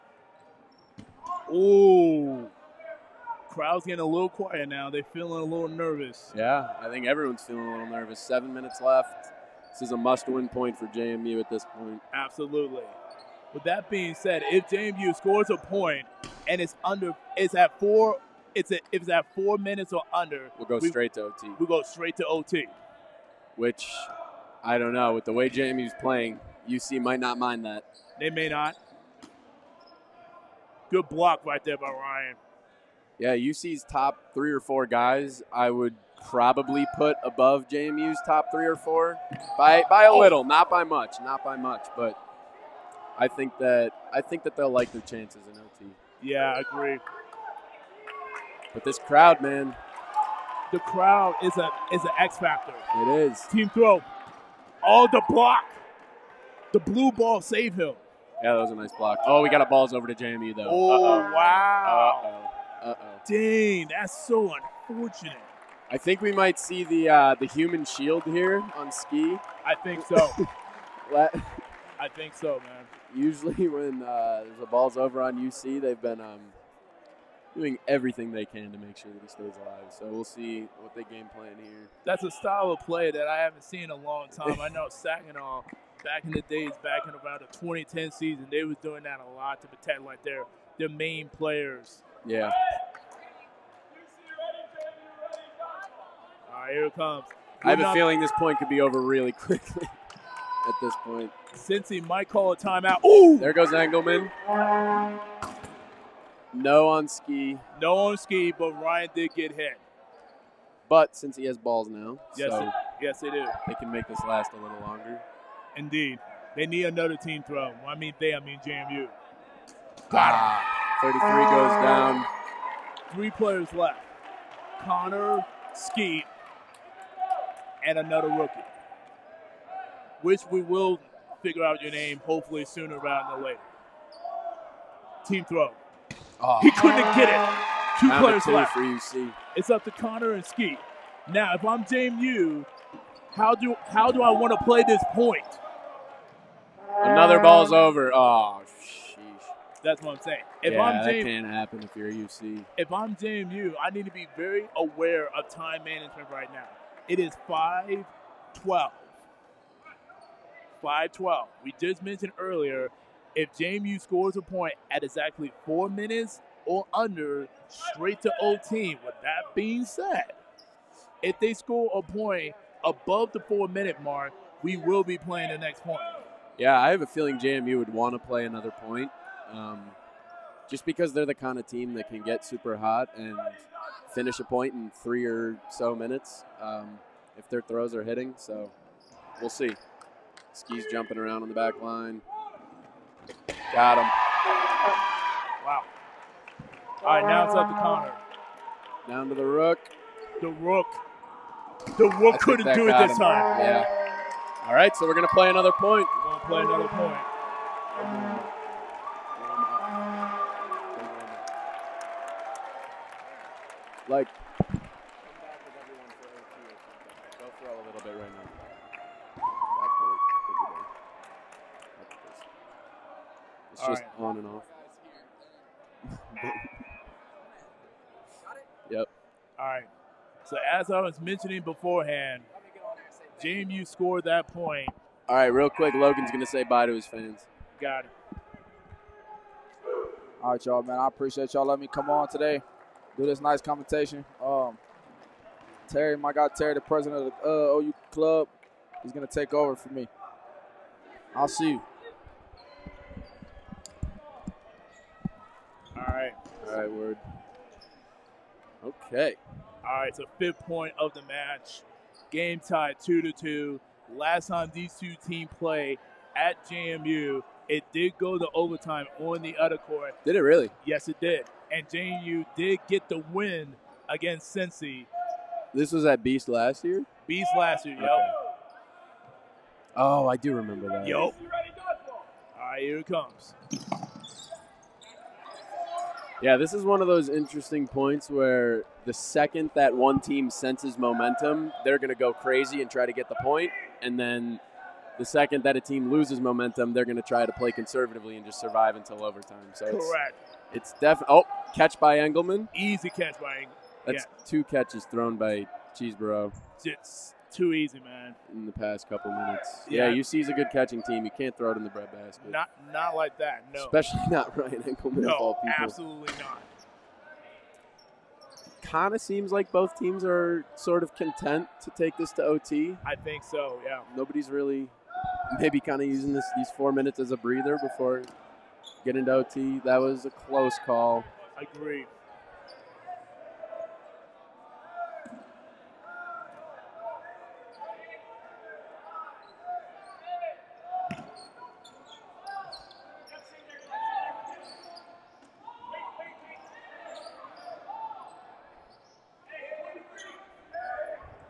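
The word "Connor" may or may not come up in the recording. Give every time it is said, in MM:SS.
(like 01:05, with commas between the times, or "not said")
02:04, 02:19, 03:17.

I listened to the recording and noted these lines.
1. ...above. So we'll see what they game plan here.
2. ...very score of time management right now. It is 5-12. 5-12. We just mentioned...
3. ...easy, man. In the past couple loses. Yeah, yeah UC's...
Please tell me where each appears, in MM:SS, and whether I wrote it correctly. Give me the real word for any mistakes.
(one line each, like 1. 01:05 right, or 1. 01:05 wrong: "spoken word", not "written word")
1. 01:19 wrong: "alive", not "above"
2. 02:34 wrong: "aware", not "score"
3. 05:07 wrong: "minutes", not "loses".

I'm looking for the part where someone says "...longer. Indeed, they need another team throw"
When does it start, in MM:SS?
01:54.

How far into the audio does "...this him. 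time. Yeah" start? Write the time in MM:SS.
03:22.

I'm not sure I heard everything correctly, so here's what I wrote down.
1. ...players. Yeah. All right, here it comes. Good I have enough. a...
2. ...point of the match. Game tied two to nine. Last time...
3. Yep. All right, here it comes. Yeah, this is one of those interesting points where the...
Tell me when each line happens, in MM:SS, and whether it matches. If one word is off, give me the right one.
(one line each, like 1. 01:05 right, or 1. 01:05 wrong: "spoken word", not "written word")
1. 01:31 right
2. 04:20 wrong: "two", not "nine"
3. 04:41 right.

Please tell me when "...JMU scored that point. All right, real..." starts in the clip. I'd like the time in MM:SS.
03:53.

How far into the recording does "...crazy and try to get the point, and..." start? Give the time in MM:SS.
04:52.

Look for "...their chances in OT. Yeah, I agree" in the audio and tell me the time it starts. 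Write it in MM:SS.
00:44.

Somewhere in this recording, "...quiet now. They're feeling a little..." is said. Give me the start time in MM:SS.
00:04.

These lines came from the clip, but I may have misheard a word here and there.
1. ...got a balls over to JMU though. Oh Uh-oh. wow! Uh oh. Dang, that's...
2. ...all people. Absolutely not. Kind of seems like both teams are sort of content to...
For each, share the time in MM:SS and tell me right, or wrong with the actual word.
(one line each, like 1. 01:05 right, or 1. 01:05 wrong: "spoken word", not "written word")
1. 00:59 right
2. 05:15 right.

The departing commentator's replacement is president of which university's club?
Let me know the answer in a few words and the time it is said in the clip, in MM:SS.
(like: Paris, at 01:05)
OU, at 04:07.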